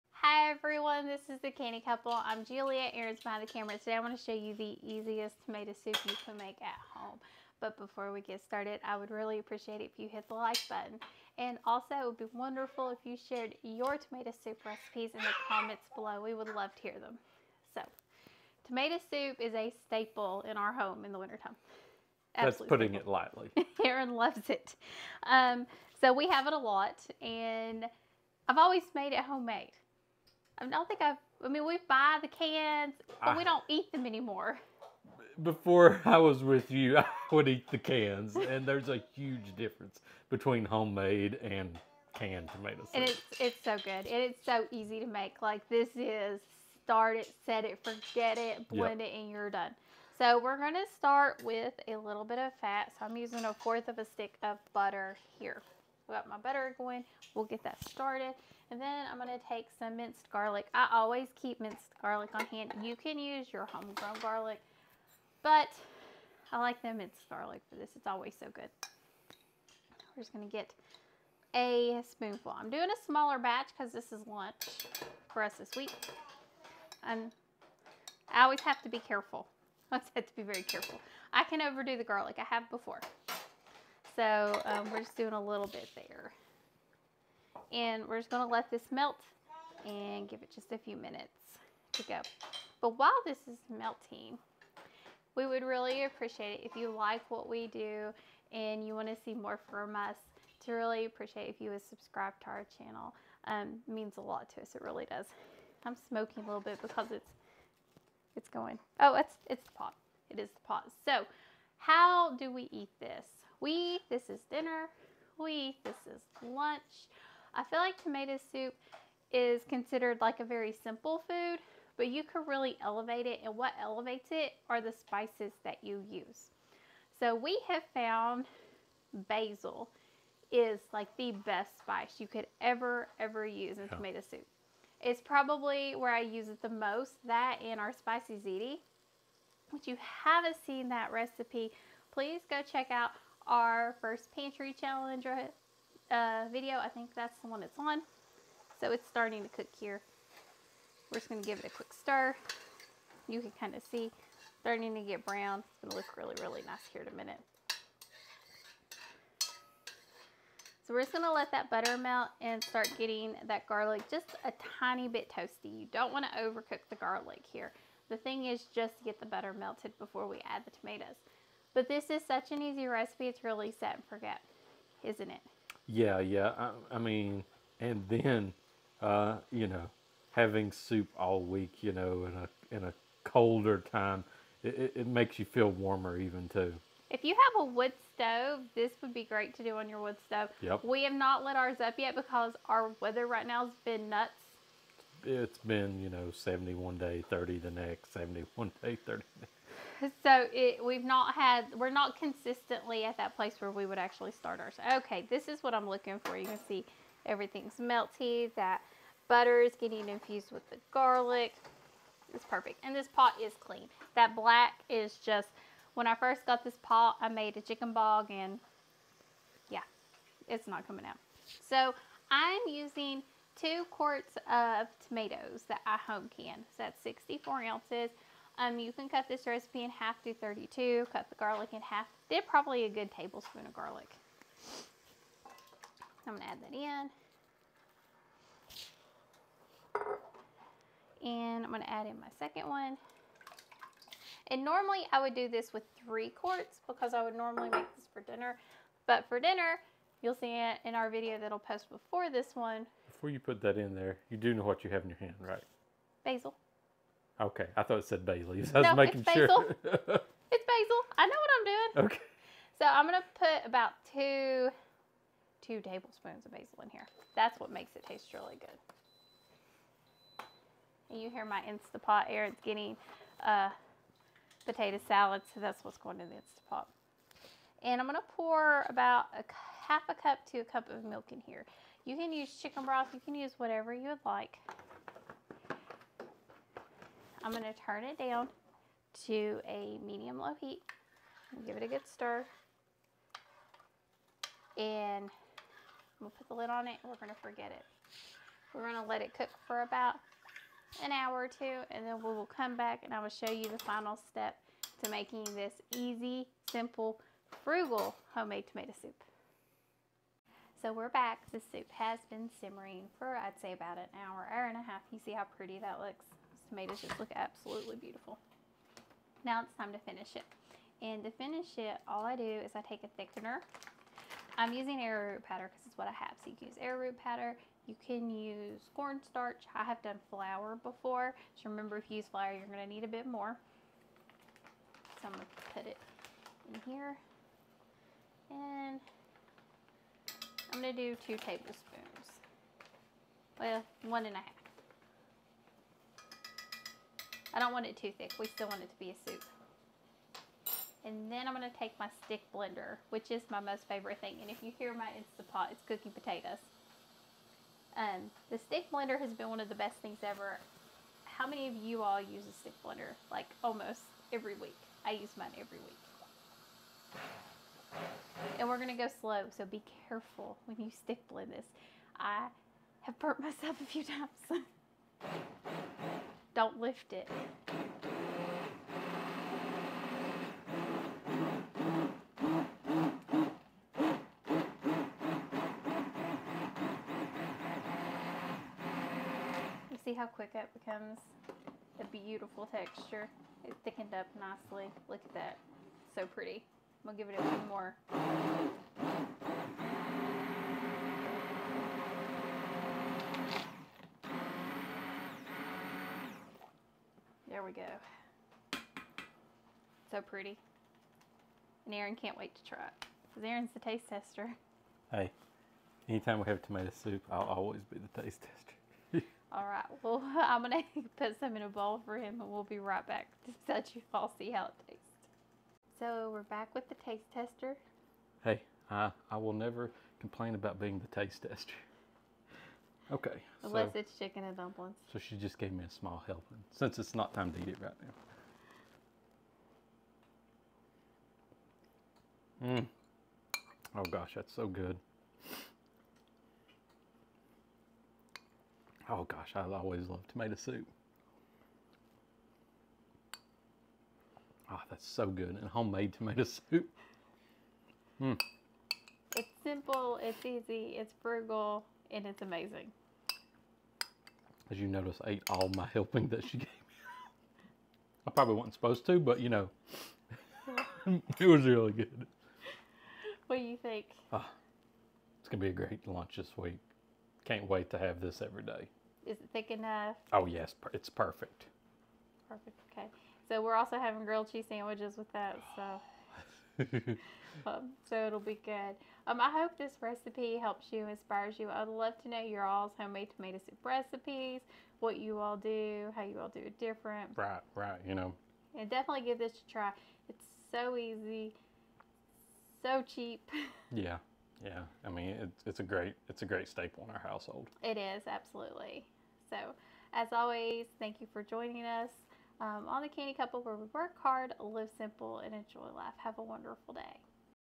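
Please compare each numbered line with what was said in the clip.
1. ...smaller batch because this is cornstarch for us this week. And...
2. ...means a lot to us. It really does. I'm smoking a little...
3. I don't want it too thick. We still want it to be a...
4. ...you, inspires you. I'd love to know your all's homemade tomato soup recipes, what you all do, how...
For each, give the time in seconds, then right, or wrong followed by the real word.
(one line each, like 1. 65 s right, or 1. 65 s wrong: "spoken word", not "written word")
1. 73 s wrong: "lunch", not "cornstarch"
2. 103 s right
3. 347 s right
4. 490 s right.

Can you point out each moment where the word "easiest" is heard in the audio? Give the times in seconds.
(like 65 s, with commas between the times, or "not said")
4 s.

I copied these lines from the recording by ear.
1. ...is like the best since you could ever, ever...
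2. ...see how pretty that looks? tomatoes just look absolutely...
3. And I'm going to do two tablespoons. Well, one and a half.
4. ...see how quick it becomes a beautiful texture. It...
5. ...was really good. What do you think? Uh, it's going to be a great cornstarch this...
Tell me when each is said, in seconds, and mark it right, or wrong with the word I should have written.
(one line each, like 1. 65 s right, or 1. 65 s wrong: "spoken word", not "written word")
1. 130 s wrong: "spice", not "since"
2. 315 s right
3. 338 s right
4. 390 s right
5. 471 s wrong: "lunch", not "cornstarch".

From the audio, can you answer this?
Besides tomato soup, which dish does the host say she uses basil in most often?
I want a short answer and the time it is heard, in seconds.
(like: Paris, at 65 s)
spicy ziti, at 137 s.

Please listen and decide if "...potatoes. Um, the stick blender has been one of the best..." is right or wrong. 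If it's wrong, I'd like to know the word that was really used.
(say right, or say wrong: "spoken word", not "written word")
right.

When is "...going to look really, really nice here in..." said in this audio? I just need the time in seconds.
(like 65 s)
155 s.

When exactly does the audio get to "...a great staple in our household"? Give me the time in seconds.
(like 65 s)
506 s.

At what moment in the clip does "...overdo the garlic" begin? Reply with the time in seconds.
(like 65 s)
81 s.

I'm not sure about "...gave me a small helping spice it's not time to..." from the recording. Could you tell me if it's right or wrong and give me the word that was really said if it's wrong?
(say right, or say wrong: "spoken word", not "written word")
wrong: "since", not "spice".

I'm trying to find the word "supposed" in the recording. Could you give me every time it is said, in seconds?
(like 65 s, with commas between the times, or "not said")
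468 s.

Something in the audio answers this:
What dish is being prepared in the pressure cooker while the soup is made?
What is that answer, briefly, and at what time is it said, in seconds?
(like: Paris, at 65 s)
potato salad, at 274 s.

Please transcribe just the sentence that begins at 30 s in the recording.
I don't think I've, I mean, we buy the cans, but I, we don't eat them anymore.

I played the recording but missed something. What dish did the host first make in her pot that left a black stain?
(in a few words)
chicken bog.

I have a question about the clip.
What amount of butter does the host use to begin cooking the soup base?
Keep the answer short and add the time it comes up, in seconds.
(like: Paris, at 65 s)
a fourth of a stick, at 53 s.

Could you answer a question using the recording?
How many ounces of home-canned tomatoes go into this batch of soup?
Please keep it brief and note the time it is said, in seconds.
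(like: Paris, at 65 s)
64, at 227 s.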